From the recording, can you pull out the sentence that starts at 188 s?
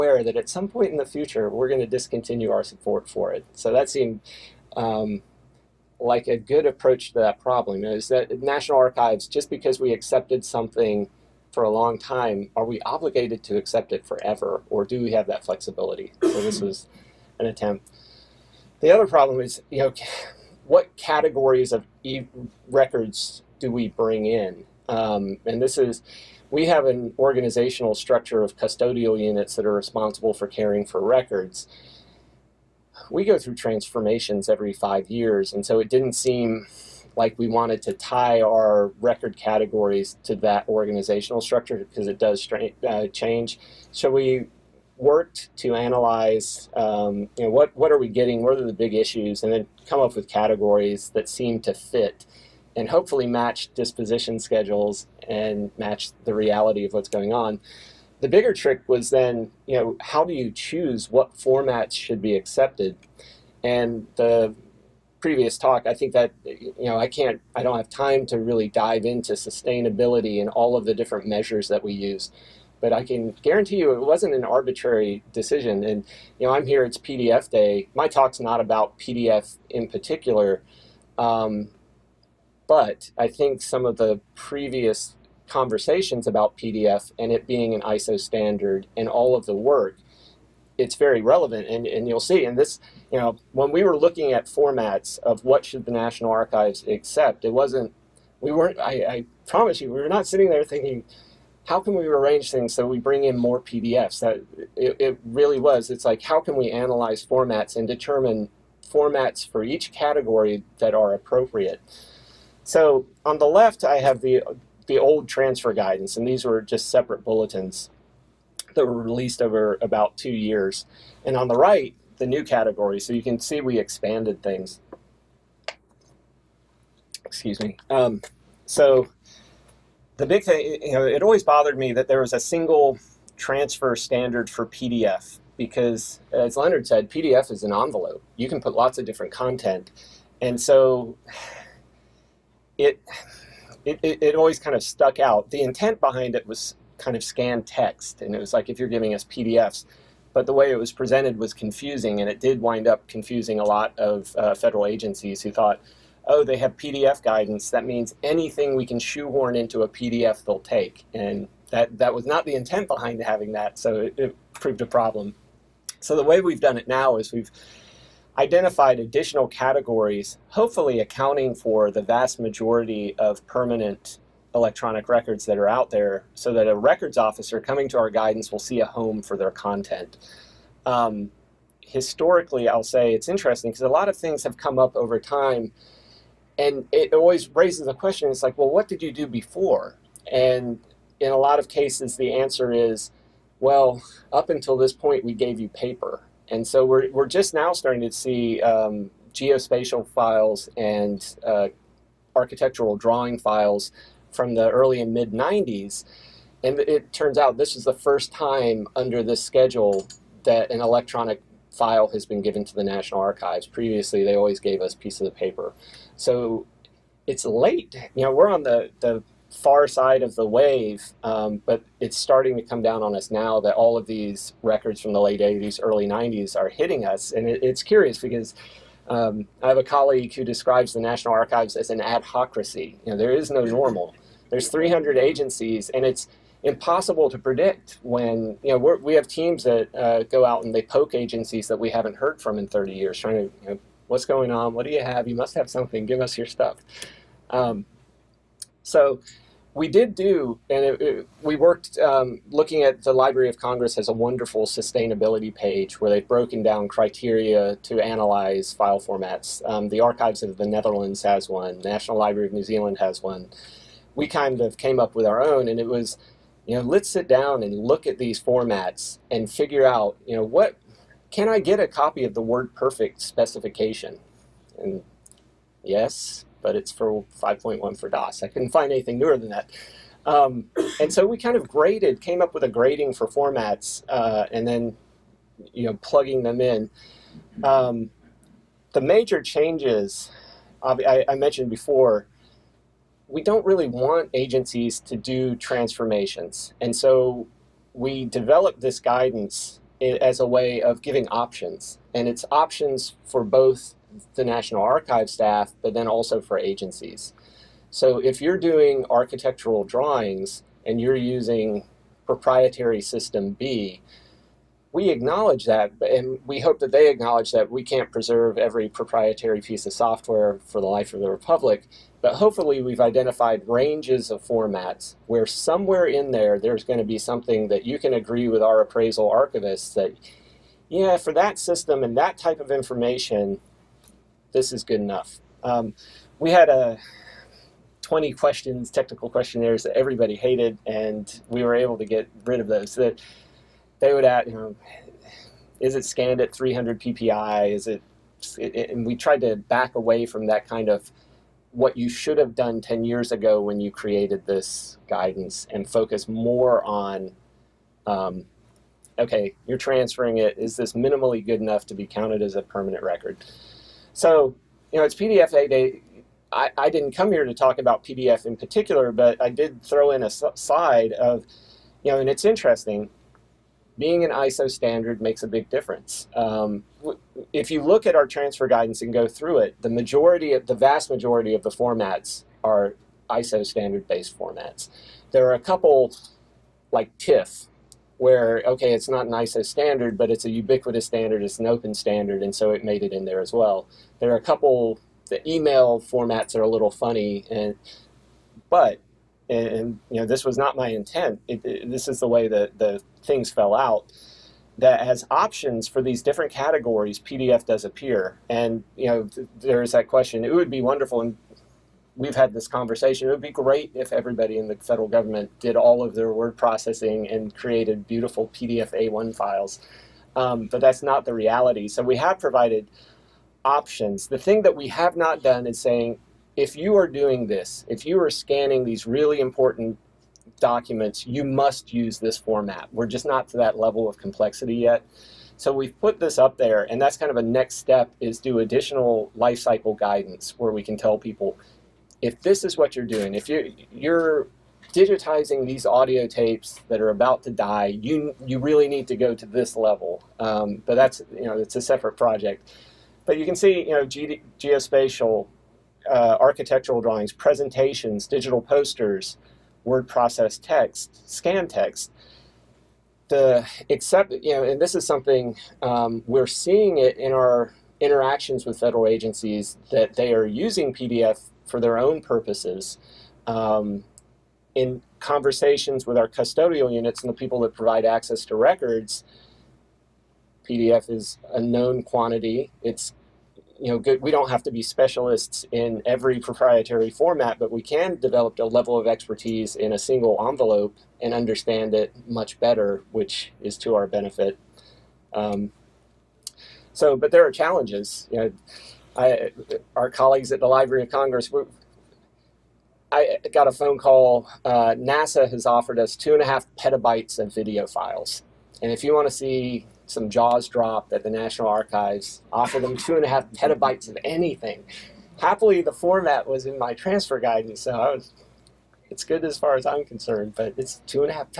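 It's like, well, what did you do before?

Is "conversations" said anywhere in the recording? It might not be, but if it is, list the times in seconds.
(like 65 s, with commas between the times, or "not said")
85 s, 412 s, 475 s.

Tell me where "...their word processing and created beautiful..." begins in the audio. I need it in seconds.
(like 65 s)
416 s.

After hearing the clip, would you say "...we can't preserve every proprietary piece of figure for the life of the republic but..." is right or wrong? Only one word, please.
wrong.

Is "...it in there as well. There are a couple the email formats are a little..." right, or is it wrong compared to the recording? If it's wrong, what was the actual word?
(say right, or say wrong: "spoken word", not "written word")
right.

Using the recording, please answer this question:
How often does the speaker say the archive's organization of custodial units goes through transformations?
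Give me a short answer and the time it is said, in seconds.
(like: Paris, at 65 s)
every 5 years, at 34 s.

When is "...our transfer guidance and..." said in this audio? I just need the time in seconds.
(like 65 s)
378 s.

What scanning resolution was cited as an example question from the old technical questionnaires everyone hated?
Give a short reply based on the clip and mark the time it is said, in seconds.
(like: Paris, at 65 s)
300 PPI, at 346 s.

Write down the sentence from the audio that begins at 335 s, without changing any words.
Um, we had a uh, 20 questions, technical questionnaires that everybody hated, and we were able to get rid of those.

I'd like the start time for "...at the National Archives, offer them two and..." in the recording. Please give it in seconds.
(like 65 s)
511 s.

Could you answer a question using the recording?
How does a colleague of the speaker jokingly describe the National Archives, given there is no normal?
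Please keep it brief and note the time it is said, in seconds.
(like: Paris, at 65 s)
an adhocracy, at 232 s.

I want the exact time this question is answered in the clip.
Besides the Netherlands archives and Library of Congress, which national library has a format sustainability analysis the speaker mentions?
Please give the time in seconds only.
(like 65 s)
261 s.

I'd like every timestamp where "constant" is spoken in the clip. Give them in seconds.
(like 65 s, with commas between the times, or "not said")
not said.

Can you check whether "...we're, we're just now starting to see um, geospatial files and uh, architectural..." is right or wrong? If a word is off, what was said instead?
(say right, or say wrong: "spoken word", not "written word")
right.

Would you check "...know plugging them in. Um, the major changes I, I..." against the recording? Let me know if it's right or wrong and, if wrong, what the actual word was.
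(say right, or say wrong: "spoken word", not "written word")
right.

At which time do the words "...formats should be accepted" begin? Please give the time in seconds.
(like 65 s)
61 s.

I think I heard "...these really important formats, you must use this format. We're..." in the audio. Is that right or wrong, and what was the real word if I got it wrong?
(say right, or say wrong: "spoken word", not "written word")
wrong: "documents", not "formats".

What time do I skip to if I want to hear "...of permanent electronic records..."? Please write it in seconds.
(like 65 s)
173 s.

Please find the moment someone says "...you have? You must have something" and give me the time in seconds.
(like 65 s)
244 s.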